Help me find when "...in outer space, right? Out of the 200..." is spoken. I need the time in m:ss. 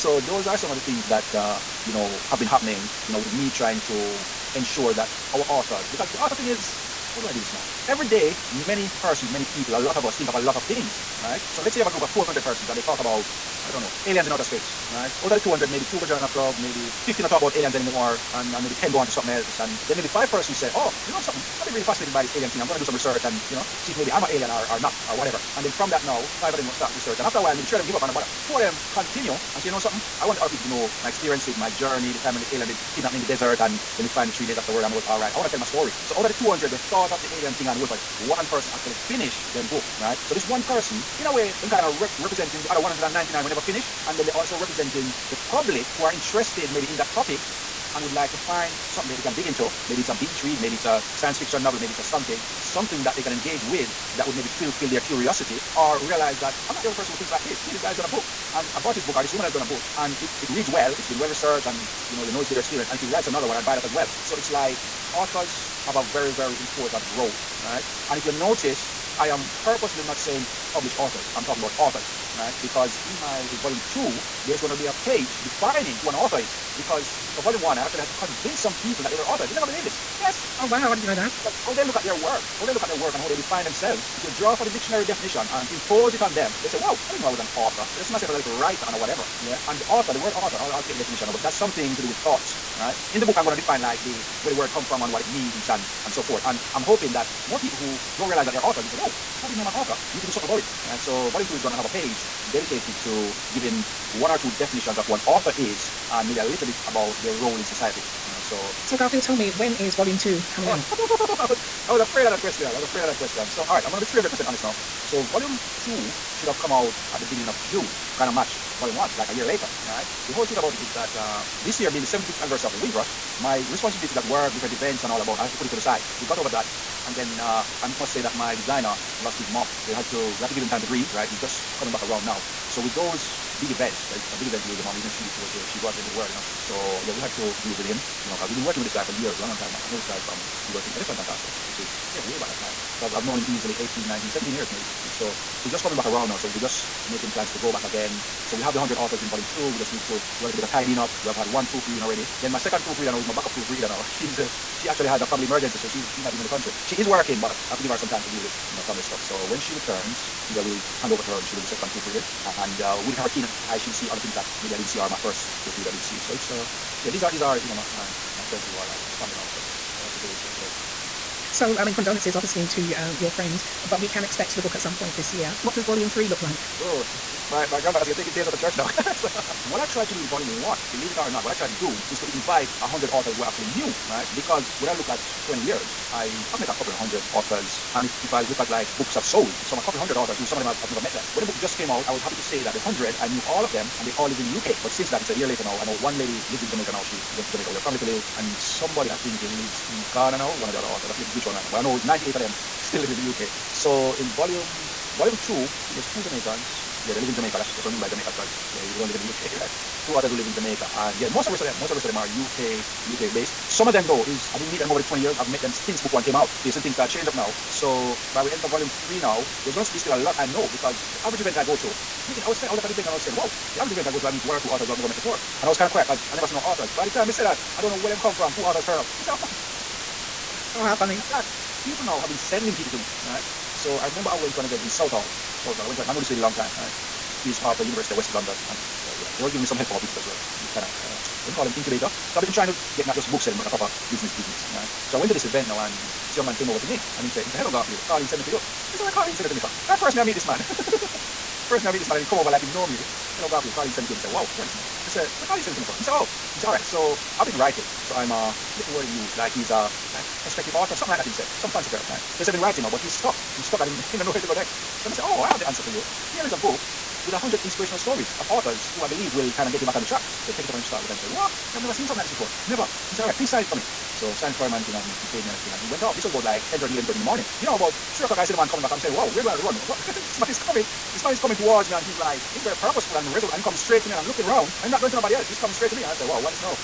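0:14.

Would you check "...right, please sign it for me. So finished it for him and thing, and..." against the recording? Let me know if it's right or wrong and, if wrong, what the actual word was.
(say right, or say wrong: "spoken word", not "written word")
wrong: "signed", not "finished".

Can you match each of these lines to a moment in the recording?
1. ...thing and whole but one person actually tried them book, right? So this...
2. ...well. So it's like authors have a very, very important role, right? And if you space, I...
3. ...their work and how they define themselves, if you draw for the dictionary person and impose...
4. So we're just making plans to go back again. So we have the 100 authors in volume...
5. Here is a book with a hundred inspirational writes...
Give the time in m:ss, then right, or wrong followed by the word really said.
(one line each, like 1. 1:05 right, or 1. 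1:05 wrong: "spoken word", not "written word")
1. 0:37 wrong: "finished", not "tried"
2. 1:03 wrong: "notice", not "space"
3. 1:22 wrong: "definition", not "person"
4. 2:26 right
5. 4:26 wrong: "stories", not "writes".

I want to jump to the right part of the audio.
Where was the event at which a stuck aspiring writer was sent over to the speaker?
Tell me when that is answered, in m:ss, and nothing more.
3:54.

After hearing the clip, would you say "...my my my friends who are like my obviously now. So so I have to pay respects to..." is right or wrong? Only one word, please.
wrong.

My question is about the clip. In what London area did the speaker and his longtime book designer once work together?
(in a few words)
Elephant and Castle.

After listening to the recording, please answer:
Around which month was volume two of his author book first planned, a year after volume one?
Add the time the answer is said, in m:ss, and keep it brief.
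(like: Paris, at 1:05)
June, at 1:57.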